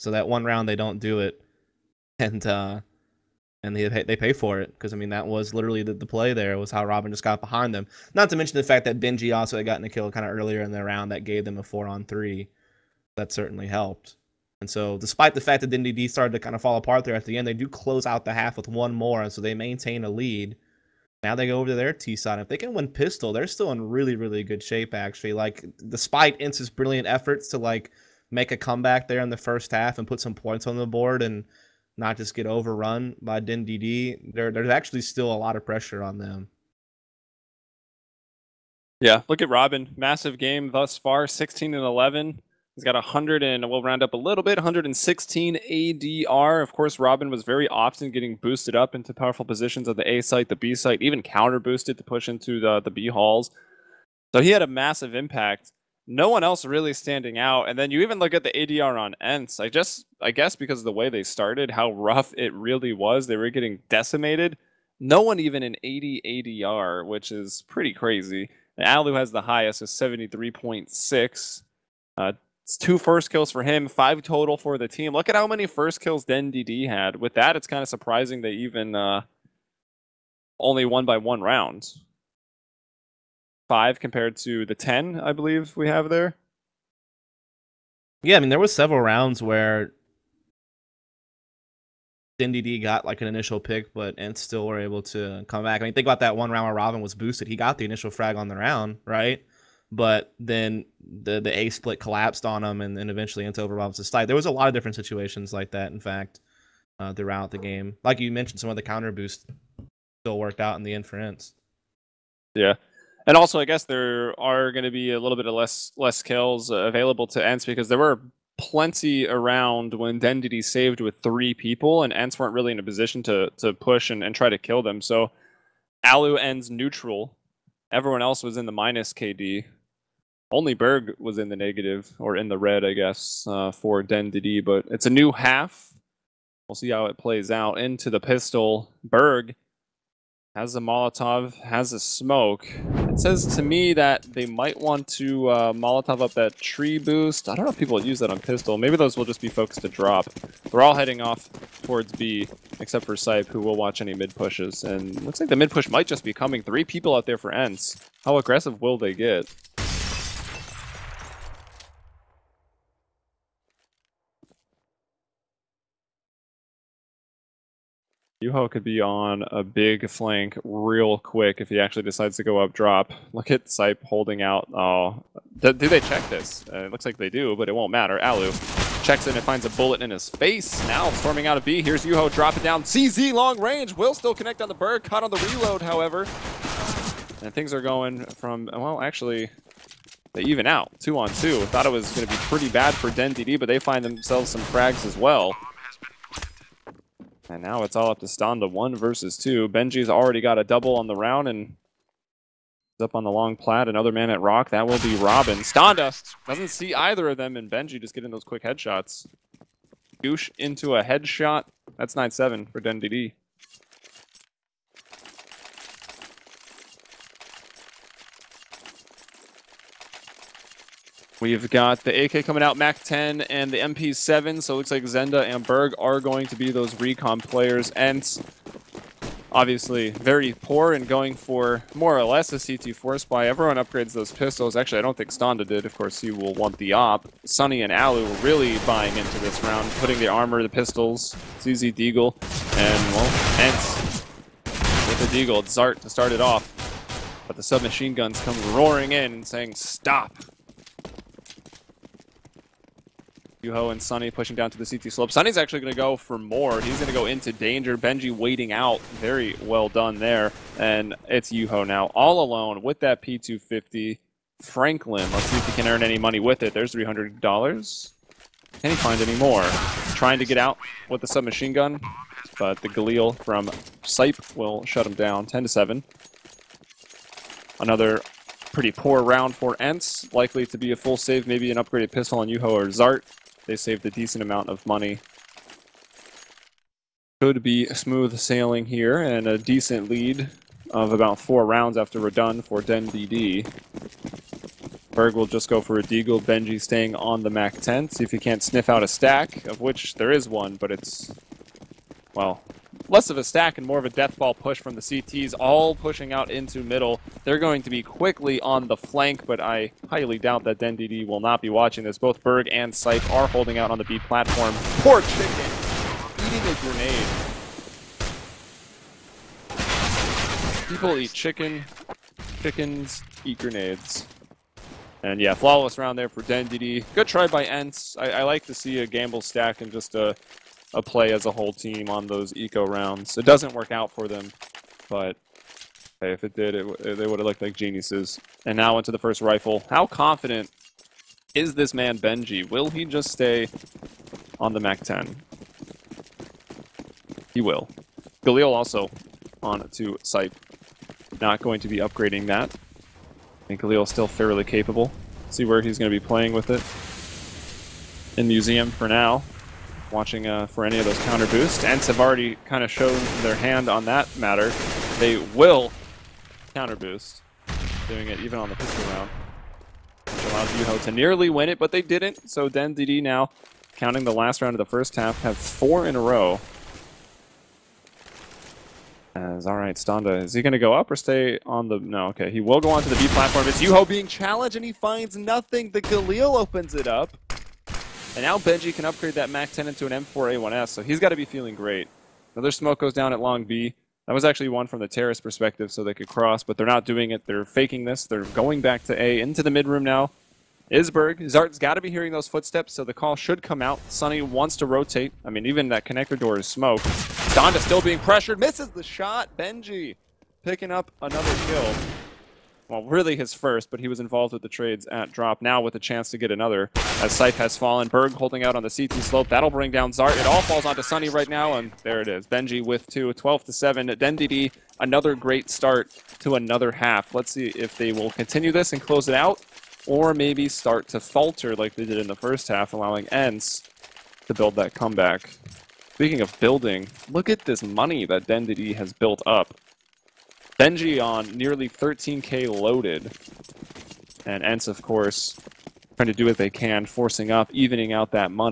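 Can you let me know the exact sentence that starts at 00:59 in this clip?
I just I guess because of the way they started, how rough it really was.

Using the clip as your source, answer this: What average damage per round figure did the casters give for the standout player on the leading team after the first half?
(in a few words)
116.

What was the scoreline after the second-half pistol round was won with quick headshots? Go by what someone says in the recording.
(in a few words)
9-7.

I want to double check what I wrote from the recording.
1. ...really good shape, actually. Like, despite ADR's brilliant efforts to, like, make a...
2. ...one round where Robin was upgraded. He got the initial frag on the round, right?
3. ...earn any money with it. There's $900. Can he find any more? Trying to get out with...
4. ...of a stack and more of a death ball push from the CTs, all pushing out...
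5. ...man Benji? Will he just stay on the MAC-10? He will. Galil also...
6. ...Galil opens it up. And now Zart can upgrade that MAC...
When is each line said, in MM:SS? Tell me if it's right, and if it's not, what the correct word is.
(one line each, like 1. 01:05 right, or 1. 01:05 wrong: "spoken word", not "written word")
1. 00:24 wrong: "ENCE", not "ADR"
2. 01:36 wrong: "boosted", not "upgraded"
3. 04:25 wrong: "300", not "900"
4. 05:03 right
5. 05:41 right
6. 06:26 wrong: "Benji", not "Zart".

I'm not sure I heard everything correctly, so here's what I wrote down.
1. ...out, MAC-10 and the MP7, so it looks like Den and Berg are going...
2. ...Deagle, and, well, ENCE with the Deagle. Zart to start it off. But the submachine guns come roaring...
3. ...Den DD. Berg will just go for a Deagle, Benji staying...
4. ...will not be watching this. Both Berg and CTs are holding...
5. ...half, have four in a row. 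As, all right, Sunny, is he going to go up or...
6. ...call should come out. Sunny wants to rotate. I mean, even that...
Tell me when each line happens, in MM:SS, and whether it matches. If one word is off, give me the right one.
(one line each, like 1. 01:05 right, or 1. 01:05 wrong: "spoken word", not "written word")
1. 03:42 wrong: "Zenda", not "Den"
2. 04:01 right
3. 04:52 right
4. 05:11 wrong: "Sype", not "CTs"
5. 06:15 wrong: "Standa", not "Sunny"
6. 06:43 right.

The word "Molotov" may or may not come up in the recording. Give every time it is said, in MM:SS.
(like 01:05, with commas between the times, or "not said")
02:20, 02:25.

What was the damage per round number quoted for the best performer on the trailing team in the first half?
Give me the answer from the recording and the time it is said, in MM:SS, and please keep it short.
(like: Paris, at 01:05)
73.6, at 01:09.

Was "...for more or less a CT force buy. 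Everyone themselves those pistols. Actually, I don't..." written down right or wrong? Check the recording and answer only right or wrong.
wrong.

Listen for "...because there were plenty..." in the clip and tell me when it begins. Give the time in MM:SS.
01:57.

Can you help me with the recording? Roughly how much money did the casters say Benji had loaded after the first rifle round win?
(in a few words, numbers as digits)
Nearly 13k.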